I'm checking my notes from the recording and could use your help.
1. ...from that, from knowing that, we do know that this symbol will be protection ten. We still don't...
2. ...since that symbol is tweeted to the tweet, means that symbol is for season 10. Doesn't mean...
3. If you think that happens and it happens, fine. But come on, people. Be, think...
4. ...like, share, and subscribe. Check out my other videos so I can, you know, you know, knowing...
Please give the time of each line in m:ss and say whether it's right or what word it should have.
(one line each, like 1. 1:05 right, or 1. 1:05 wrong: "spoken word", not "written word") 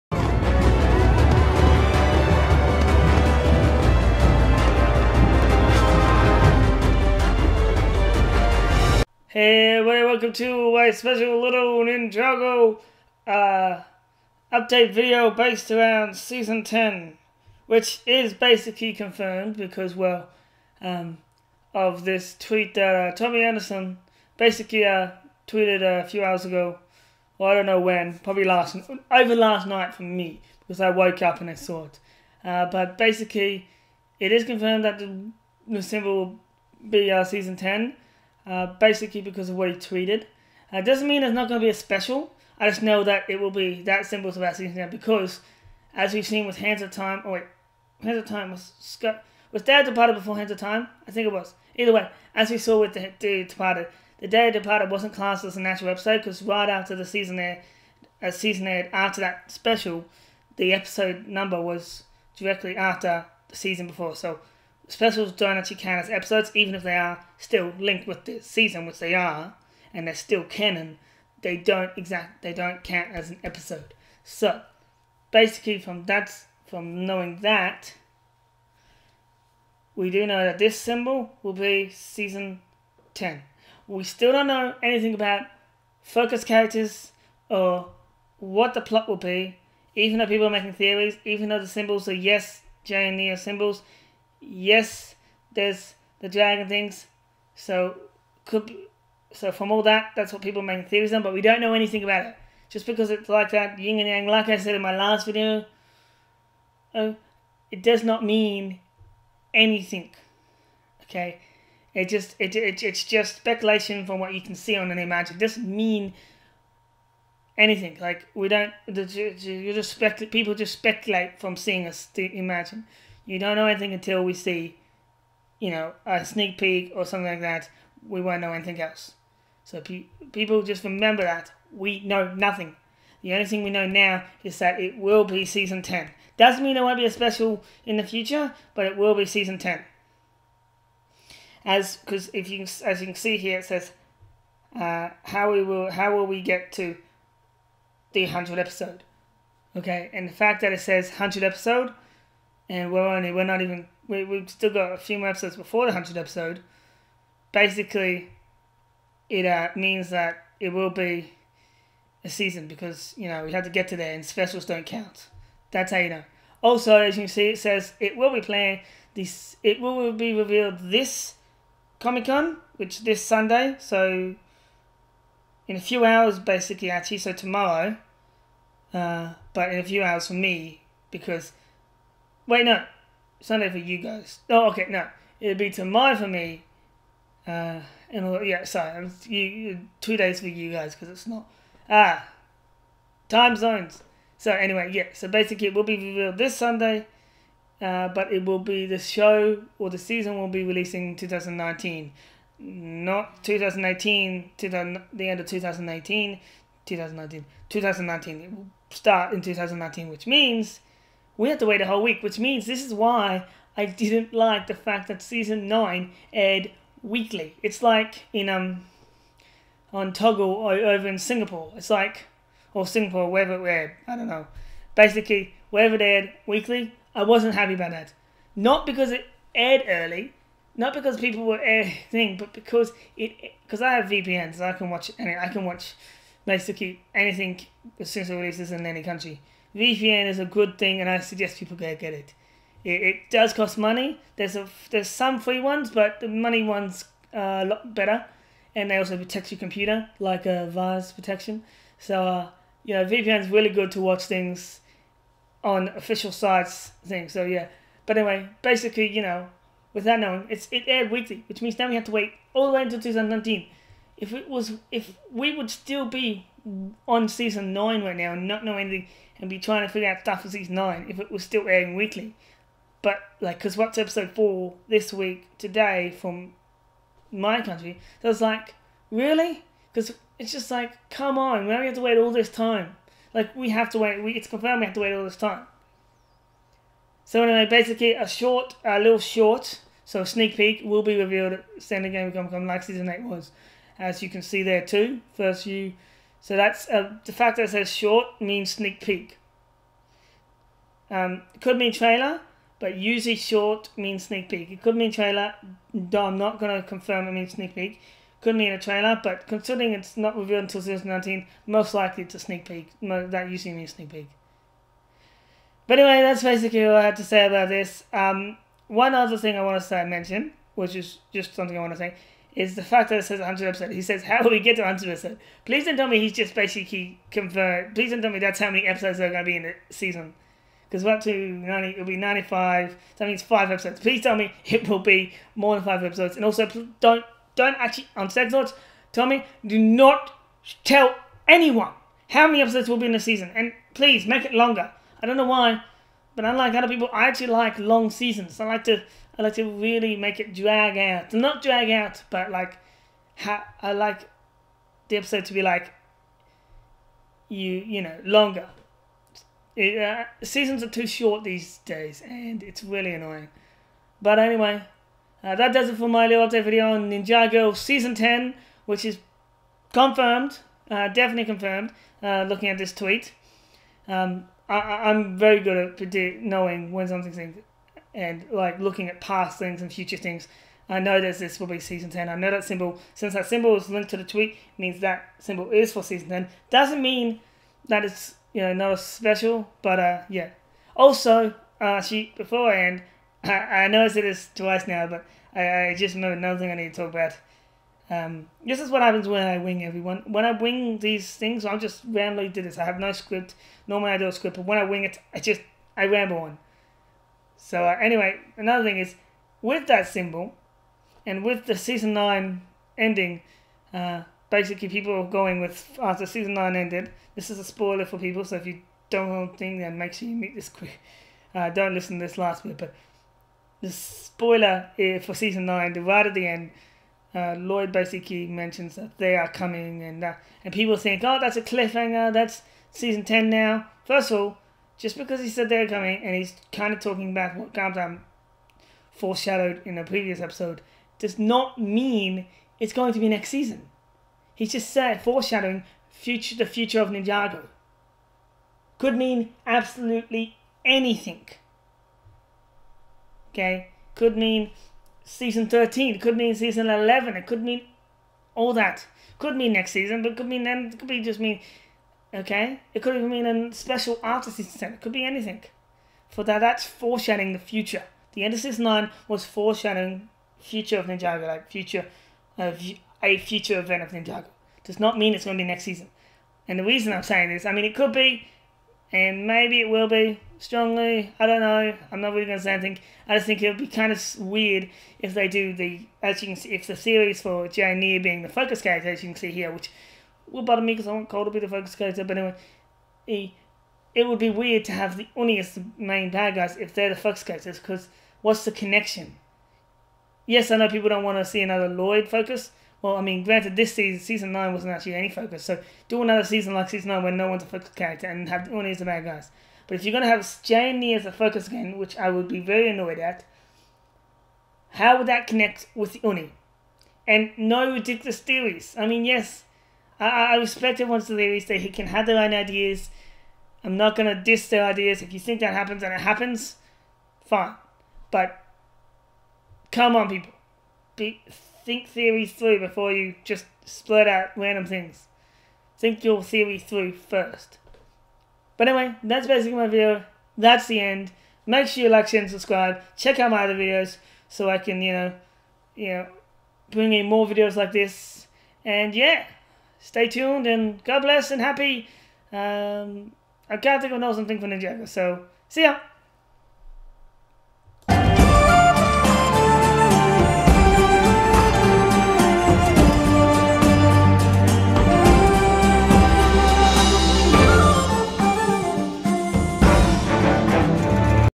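1. 1:15 wrong: "season", not "protection"
2. 6:23 wrong: "linked", not "tweeted"
3. 8:45 right
4. 9:02 wrong: "bring", not "knowing".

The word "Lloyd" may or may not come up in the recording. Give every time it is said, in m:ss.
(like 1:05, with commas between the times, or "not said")
7:07, 8:21.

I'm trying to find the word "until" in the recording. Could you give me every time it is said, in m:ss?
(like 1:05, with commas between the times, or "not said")
2:03, 4:22, 5:10.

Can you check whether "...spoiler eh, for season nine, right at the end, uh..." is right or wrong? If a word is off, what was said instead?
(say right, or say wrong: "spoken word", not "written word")
right.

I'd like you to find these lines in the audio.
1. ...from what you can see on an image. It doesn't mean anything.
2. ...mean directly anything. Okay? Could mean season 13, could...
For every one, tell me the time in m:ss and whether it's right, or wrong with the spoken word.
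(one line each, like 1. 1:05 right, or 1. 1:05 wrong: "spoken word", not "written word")
1. 1:54 right
2. 7:29 wrong: "absolutely", not "directly".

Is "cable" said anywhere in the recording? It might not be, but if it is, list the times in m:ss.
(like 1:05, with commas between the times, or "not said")
not said.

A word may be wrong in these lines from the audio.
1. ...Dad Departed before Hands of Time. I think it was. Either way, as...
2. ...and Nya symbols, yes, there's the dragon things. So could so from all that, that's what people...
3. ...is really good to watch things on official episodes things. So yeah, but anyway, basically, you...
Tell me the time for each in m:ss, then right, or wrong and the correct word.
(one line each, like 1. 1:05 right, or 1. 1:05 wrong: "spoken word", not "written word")
1. 0:49 right
2. 1:33 right
3. 4:13 wrong: "sites", not "episodes".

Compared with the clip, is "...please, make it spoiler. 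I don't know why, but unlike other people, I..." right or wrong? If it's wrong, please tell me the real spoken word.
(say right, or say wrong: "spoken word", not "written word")
wrong: "longer", not "spoiler".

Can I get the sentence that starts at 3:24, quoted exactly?
to the end of 2018, 2019, 2019.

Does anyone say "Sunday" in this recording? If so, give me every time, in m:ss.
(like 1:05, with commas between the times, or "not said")
2:53, 3:03, 3:16.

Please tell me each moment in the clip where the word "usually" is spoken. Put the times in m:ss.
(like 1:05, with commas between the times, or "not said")
5:02, 5:13.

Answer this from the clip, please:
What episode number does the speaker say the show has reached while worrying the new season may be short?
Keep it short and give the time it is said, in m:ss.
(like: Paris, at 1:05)
90, at 5:31.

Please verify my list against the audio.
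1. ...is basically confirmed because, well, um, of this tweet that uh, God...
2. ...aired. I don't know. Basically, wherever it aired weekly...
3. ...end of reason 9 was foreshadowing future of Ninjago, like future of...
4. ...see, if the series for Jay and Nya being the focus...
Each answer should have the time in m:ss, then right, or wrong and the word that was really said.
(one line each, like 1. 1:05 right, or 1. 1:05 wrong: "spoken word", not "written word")
1. 0:18 wrong: "Tommy", not "God"
2. 3:43 right
3. 7:48 wrong: "season", not "reason"
4. 8:06 right.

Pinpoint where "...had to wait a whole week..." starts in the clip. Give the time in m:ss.
3:31.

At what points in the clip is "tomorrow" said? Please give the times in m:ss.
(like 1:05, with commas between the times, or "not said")
2:57, 3:05.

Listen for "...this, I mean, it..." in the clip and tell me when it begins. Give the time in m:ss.
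7:57.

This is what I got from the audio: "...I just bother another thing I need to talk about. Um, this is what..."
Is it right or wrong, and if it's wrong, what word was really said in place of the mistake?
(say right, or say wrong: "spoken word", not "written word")
wrong: "remember", not "bother".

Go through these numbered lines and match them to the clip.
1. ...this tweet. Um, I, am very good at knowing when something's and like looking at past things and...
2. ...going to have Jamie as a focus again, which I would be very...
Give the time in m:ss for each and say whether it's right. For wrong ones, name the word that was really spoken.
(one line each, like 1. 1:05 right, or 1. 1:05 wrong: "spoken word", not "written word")
1. 6:12 right
2. 8:30 right.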